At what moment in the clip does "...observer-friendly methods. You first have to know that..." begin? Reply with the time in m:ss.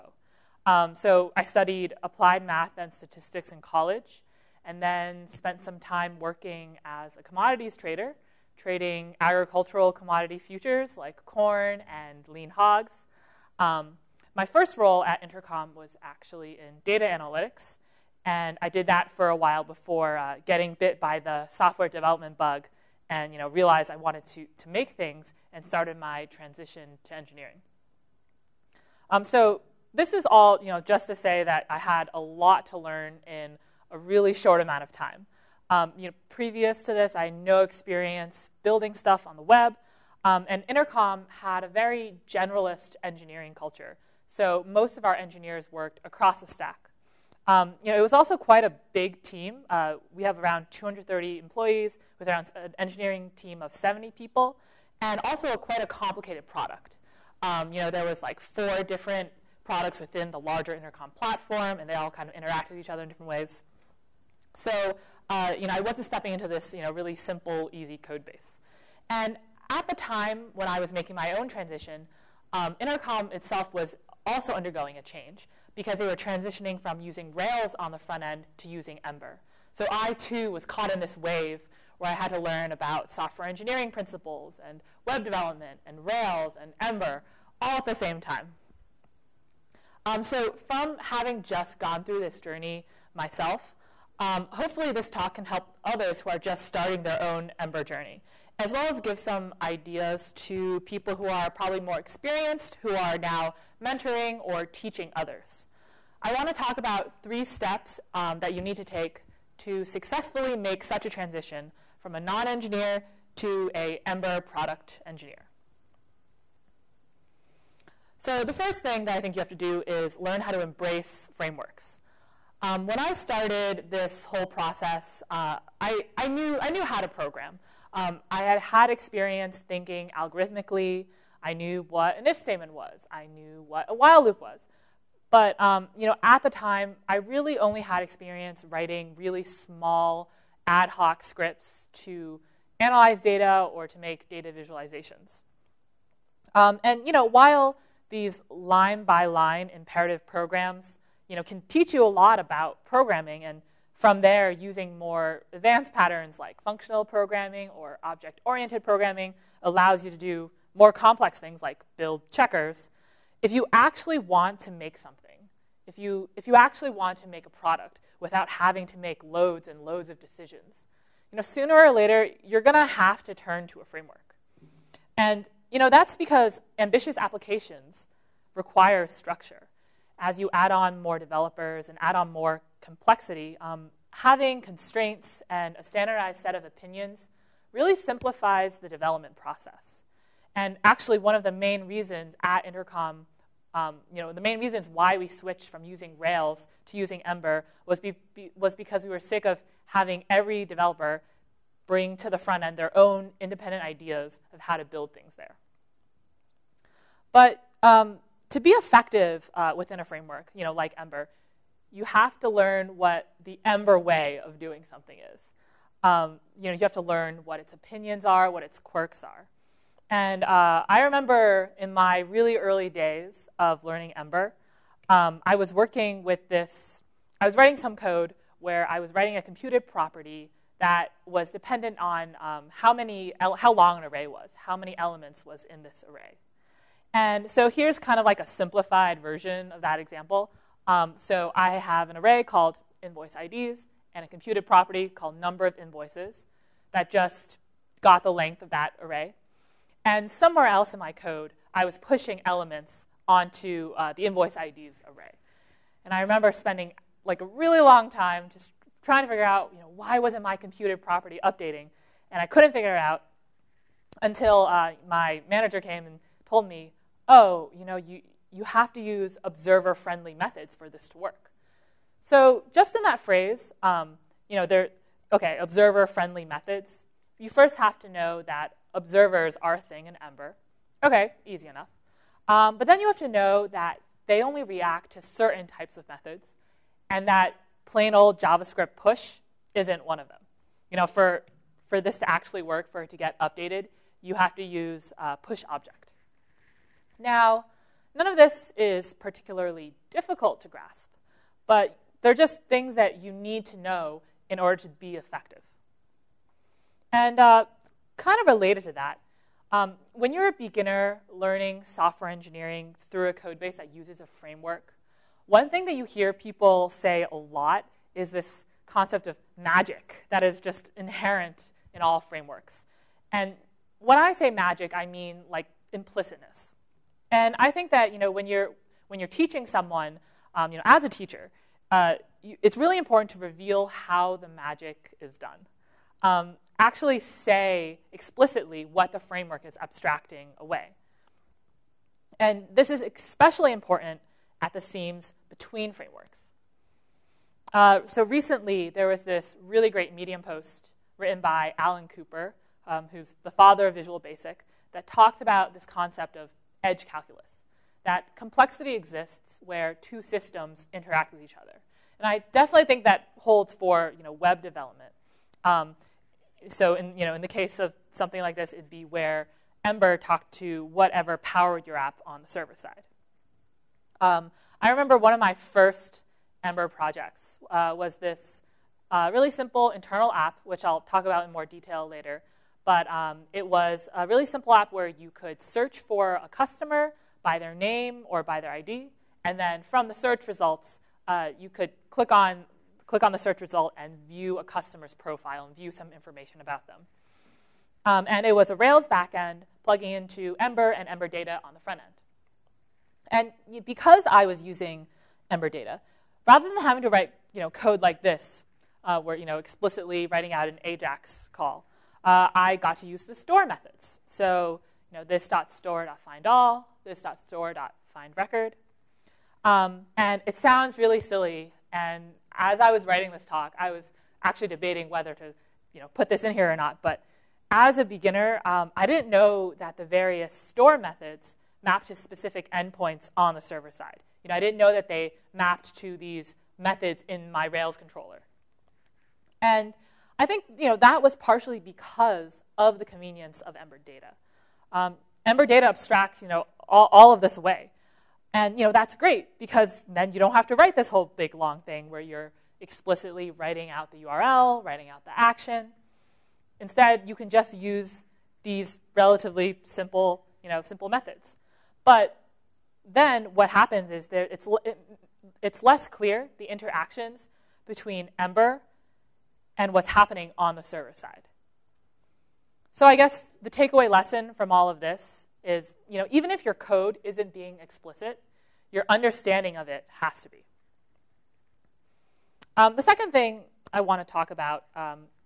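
4:35.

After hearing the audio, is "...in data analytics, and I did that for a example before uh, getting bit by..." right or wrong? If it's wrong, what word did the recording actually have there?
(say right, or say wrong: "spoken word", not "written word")
wrong: "while", not "example".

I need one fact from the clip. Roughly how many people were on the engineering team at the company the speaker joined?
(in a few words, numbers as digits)
70.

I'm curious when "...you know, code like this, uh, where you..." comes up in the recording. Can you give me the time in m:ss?
6:47.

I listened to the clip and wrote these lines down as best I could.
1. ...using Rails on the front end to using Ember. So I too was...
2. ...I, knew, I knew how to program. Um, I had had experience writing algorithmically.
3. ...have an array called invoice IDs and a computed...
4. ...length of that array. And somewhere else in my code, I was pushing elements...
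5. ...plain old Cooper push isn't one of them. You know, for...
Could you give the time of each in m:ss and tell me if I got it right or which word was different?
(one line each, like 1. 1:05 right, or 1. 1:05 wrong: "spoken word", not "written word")
1. 1:17 right
2. 2:06 wrong: "thinking", not "writing"
3. 4:01 right
4. 4:08 right
5. 4:47 wrong: "JavaScript", not "Cooper".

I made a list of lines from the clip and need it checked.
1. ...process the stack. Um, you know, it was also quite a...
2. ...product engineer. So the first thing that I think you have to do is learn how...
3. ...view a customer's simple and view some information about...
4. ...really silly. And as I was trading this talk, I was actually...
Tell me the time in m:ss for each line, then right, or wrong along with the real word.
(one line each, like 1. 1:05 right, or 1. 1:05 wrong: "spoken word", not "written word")
1. 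0:46 wrong: "across", not "process"
2. 1:54 right
3. 6:34 wrong: "profile", not "simple"
4. 7:00 wrong: "writing", not "trading".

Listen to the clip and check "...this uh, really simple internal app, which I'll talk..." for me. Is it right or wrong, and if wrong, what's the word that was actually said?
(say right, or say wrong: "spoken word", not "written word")
right.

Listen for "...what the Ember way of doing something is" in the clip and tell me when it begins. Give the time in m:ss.
3:32.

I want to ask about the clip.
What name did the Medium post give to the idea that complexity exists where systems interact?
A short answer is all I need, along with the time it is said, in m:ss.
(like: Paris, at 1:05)
edge calculus, at 5:56.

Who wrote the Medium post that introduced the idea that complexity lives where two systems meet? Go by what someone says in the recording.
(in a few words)
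Alan Cooper.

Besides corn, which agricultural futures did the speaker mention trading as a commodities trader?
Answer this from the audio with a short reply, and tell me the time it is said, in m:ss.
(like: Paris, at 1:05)
lean hogs, at 0:12.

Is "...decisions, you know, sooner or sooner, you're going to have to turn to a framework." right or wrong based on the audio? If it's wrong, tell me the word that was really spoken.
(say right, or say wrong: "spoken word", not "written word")
wrong: "later", not "sooner".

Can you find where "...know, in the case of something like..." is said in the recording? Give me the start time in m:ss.
6:07.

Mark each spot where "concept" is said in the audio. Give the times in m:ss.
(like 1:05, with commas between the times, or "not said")
5:18, 5:55.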